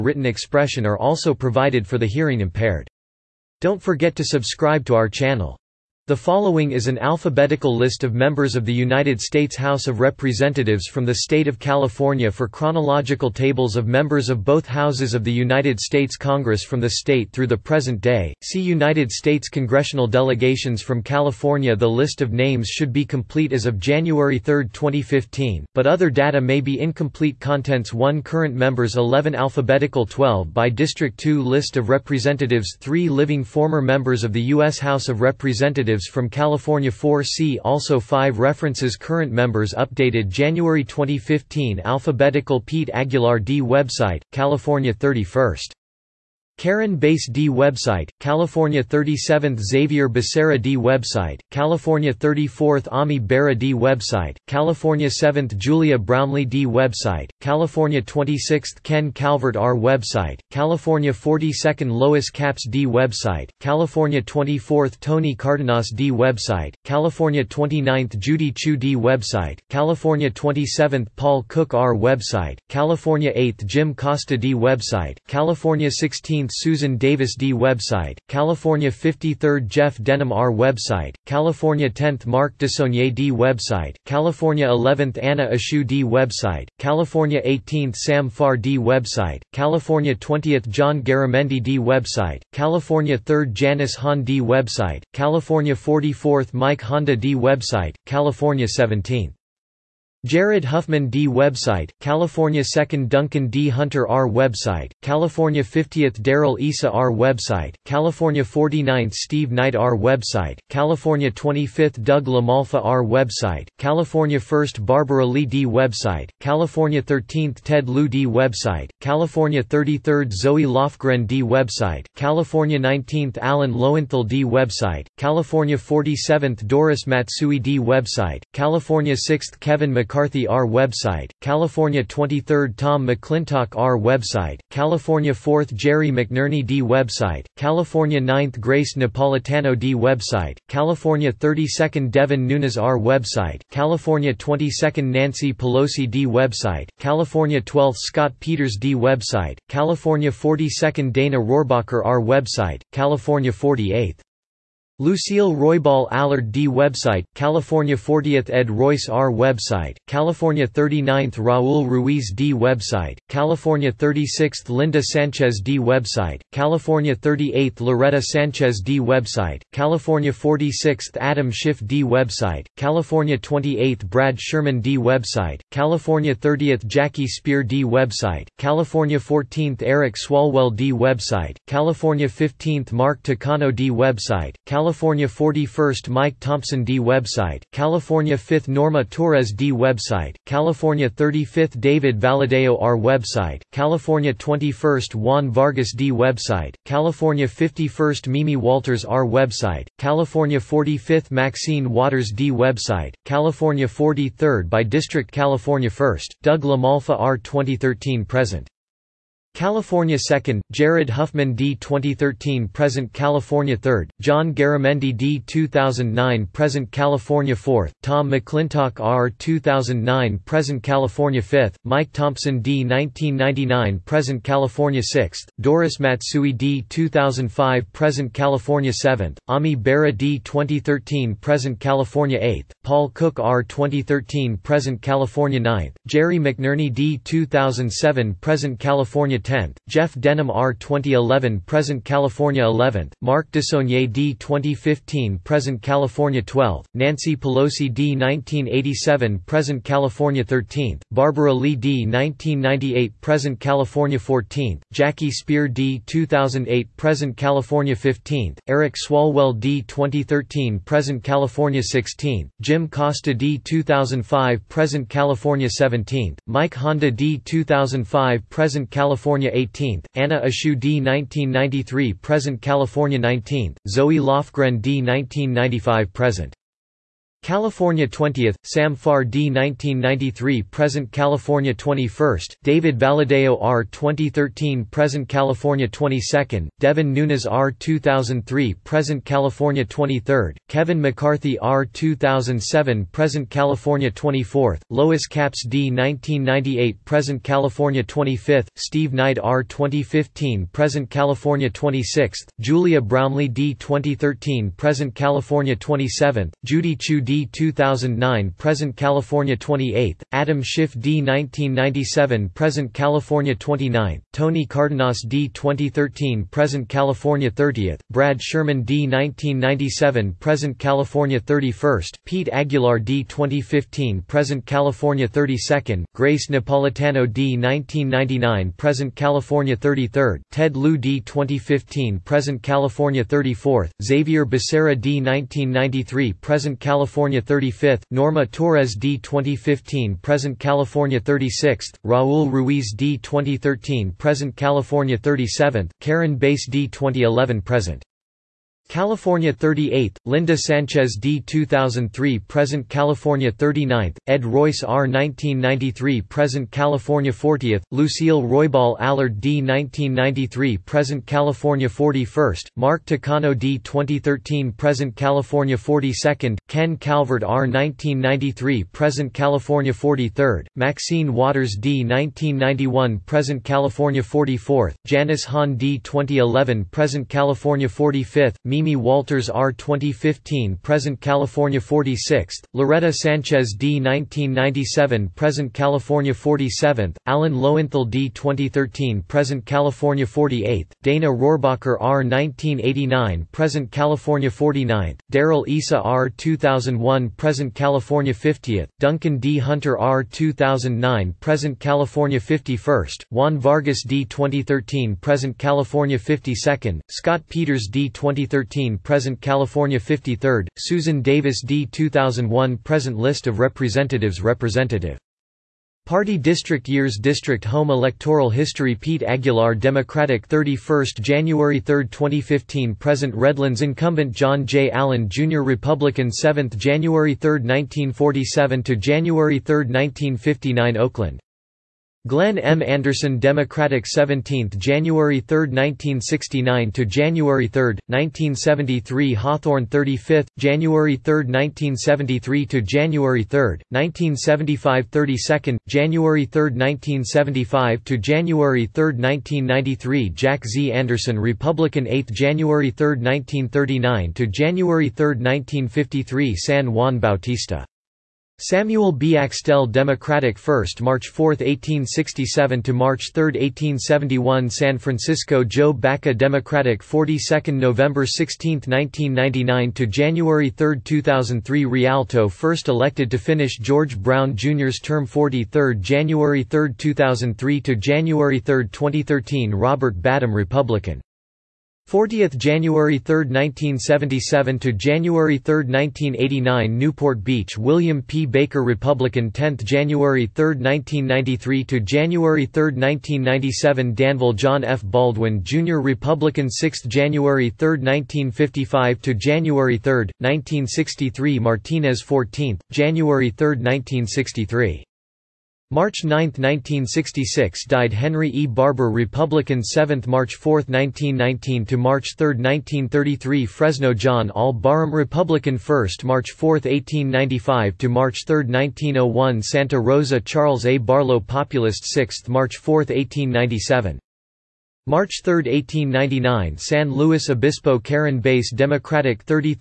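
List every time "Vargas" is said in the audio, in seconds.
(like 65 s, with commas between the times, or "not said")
195 s, 403 s.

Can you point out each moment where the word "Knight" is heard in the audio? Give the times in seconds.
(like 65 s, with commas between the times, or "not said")
109 s, 299 s.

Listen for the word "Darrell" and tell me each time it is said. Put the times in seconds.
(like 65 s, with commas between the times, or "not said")
106 s, 395 s.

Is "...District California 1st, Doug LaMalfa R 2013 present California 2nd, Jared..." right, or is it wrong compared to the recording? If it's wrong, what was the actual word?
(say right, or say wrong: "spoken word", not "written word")
right.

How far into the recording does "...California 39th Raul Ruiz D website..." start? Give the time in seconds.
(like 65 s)
160 s.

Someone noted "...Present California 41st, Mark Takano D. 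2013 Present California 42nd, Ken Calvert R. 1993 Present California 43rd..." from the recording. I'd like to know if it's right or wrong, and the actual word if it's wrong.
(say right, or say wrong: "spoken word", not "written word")
right.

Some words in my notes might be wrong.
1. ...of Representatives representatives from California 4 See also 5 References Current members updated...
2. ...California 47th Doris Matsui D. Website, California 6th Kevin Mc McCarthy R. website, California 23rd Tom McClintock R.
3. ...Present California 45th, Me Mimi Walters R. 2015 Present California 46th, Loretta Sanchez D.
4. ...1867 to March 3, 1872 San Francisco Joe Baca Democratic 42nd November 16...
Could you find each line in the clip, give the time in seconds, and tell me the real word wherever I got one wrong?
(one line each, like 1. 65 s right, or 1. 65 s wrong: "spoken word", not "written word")
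1. 35 s right
2. 125 s right
3. 376 s right
4. 461 s wrong: "1871", not "1872".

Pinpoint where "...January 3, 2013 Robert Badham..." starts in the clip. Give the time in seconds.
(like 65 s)
477 s.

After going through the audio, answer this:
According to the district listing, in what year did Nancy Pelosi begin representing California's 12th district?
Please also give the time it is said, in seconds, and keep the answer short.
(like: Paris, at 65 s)
1987, at 248 s.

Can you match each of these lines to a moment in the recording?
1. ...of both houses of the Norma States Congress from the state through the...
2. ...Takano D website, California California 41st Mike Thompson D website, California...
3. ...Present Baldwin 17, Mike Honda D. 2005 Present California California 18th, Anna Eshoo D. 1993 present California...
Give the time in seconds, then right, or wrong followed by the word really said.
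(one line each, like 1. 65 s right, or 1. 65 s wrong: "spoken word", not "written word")
1. 14 s wrong: "United", not "Norma"
2. 183 s right
3. 264 s wrong: "California", not "Baldwin".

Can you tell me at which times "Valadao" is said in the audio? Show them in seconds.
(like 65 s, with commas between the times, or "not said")
192 s, 282 s.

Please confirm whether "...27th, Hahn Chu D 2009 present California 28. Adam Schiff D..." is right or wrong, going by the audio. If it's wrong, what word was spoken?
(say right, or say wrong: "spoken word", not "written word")
wrong: "Judy", not "Hahn".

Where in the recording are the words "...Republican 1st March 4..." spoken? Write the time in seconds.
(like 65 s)
515 s.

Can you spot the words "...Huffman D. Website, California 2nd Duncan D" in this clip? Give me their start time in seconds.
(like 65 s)
100 s.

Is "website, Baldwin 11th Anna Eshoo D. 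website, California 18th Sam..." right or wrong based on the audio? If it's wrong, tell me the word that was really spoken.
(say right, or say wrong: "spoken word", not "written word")
wrong: "California", not "Baldwin".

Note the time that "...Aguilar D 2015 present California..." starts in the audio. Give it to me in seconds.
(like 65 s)
322 s.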